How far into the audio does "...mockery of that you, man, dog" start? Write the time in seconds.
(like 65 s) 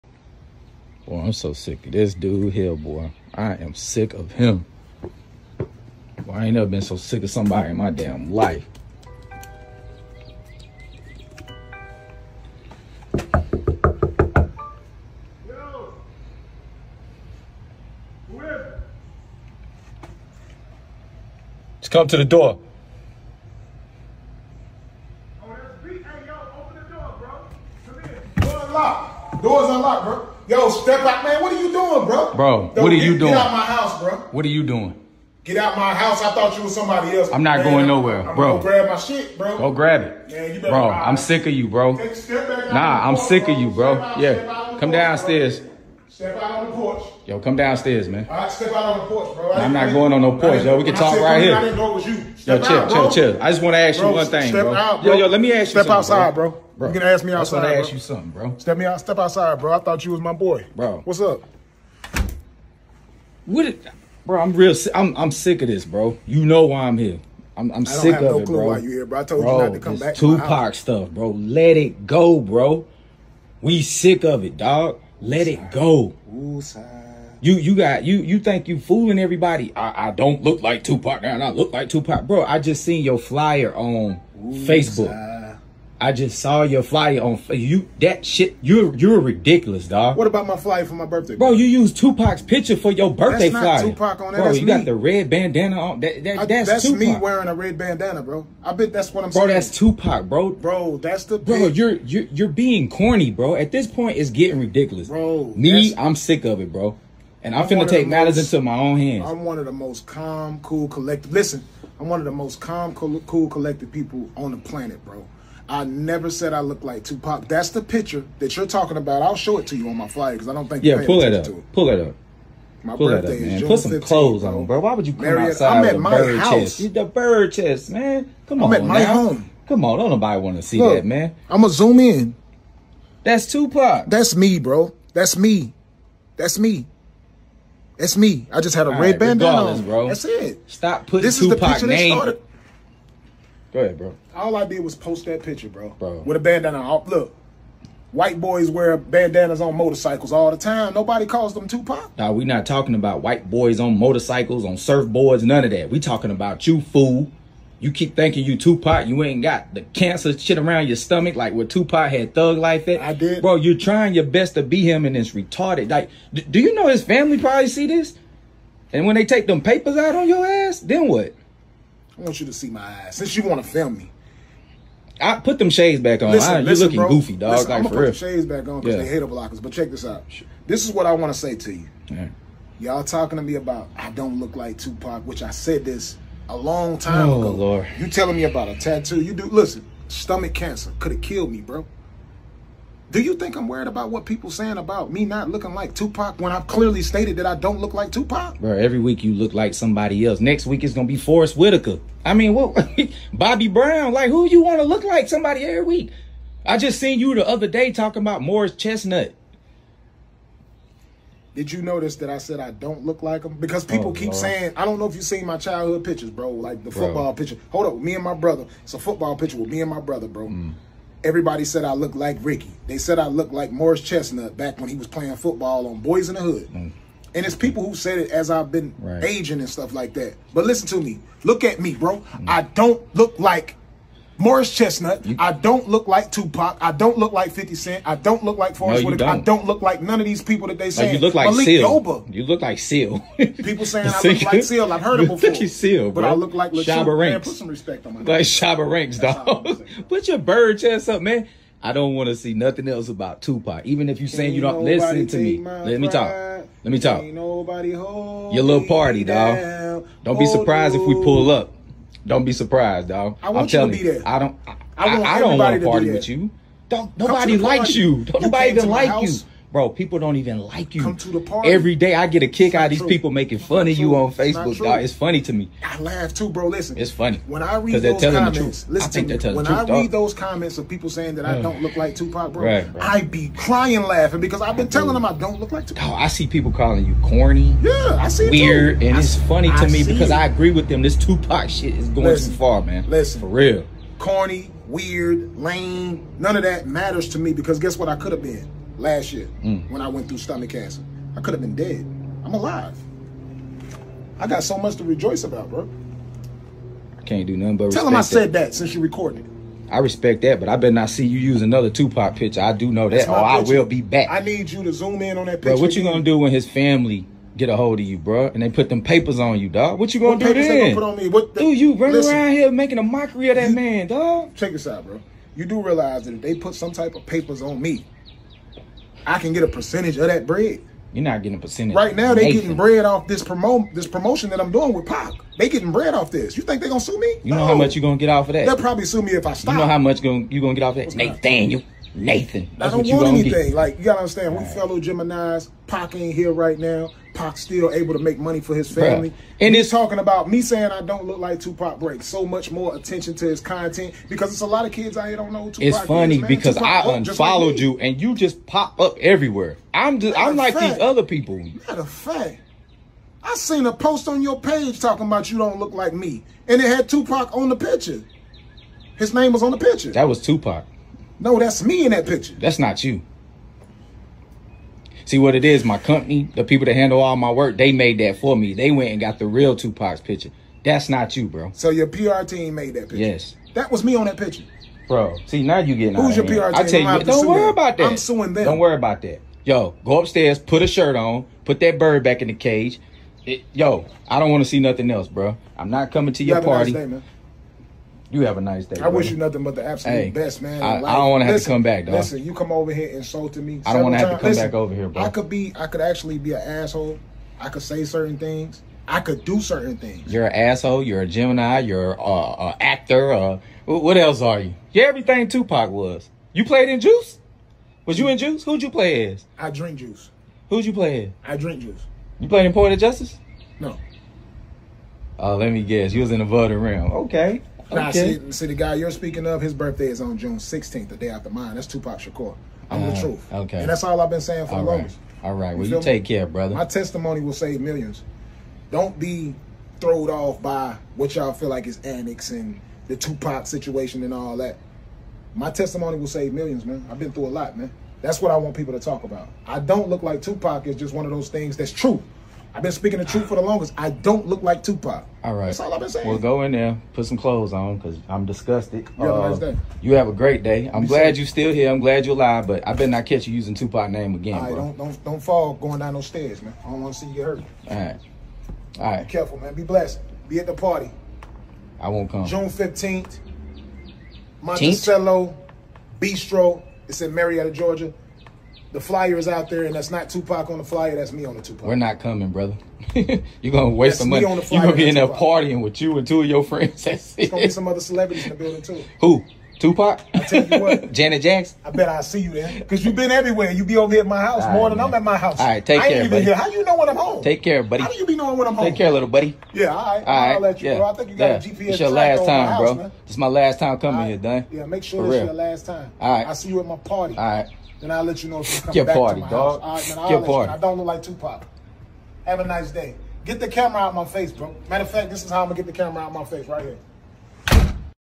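323 s.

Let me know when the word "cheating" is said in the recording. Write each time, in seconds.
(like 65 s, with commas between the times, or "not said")
not said.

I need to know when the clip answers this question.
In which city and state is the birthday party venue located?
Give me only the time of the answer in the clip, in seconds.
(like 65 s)
477 s.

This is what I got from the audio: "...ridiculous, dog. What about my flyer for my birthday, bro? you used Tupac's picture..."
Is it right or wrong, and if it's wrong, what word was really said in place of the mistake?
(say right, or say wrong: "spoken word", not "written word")
right.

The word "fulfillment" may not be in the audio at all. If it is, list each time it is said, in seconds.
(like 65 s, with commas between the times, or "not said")
not said.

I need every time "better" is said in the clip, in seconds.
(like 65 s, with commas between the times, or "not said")
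310 s, 462 s.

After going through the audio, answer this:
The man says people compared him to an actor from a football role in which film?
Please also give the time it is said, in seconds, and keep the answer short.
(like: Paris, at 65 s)
Boyz n the Hood, at 226 s.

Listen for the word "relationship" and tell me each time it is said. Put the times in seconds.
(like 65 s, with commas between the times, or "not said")
not said.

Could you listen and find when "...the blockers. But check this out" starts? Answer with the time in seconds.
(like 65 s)
179 s.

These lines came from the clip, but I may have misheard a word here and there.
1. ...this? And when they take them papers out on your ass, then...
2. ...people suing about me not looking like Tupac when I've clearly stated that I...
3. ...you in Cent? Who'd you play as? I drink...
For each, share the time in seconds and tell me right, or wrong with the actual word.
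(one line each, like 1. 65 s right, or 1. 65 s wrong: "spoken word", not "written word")
1. 167 s right
2. 194 s wrong: "saying", not "suing"
3. 418 s wrong: "Juice", not "Cent".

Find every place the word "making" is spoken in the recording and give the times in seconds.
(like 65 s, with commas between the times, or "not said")
273 s, 322 s.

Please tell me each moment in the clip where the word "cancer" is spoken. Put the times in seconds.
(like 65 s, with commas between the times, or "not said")
159 s, 190 s, 300 s.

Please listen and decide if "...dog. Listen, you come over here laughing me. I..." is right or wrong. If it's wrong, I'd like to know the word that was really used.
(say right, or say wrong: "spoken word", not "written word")
wrong: "insulting", not "laughing".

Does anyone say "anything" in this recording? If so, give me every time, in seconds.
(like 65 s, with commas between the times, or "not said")
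343 s.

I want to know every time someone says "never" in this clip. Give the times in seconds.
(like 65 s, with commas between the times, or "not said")
6 s, 115 s.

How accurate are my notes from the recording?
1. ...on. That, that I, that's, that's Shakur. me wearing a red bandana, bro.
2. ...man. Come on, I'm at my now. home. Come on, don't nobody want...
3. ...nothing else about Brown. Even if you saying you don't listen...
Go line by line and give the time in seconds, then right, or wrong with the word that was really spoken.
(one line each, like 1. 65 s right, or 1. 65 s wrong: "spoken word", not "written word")
1. 95 s wrong: "Tupac", not "Shakur"
2. 127 s right
3. 252 s wrong: "Tupac", not "Brown".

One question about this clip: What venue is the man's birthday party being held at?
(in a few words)
Monticello Bistro.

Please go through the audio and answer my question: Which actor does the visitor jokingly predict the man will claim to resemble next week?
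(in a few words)
Forest Whitaker.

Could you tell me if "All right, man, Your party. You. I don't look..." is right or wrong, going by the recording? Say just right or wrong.
right.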